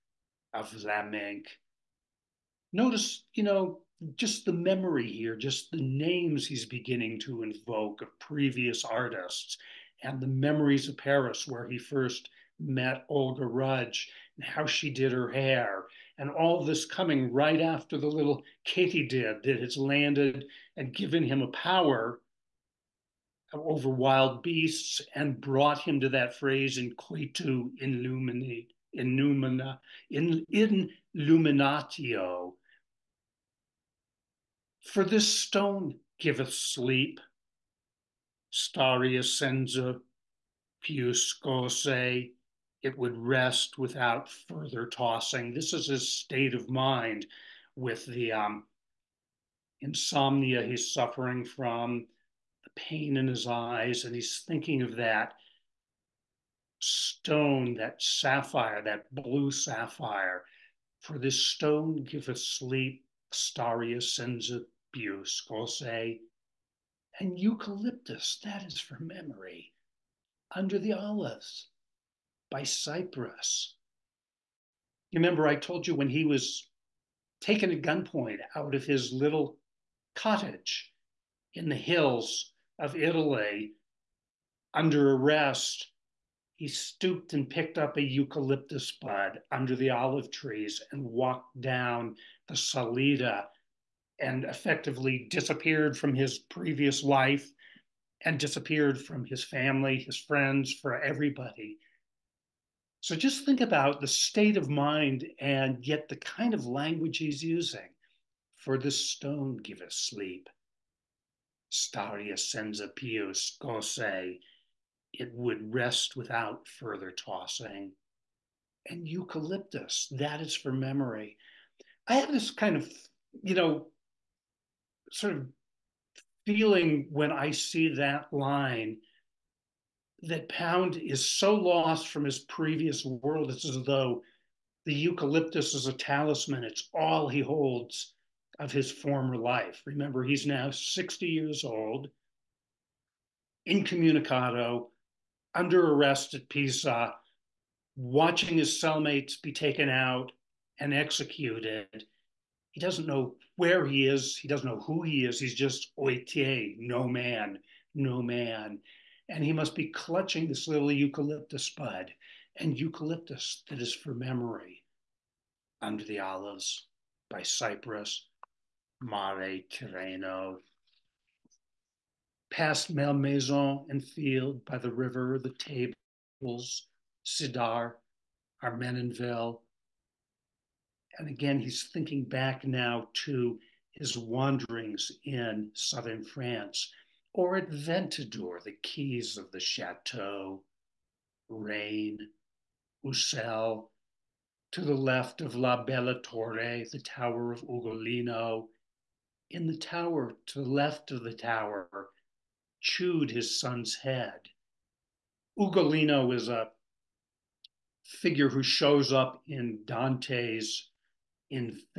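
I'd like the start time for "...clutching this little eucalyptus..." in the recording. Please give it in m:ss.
2:39.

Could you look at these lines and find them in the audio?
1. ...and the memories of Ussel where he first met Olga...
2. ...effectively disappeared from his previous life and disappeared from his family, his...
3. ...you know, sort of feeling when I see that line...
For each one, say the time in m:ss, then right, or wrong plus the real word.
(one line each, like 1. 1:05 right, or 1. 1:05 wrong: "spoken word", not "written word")
1. 0:10 wrong: "Paris", not "Ussel"
2. 1:34 right
3. 2:03 right.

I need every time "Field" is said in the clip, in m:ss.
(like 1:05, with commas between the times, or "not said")
2:54.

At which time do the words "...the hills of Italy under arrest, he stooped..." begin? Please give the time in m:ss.
1:21.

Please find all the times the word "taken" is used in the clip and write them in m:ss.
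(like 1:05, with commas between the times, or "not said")
1:17, 2:29.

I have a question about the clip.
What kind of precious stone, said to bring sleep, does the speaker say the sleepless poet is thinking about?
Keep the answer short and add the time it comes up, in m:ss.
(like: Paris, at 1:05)
blue sapphire, at 0:59.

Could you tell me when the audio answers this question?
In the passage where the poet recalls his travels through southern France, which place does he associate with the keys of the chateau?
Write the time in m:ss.
3:07.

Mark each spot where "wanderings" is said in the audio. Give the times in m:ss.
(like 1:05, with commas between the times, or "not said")
3:04.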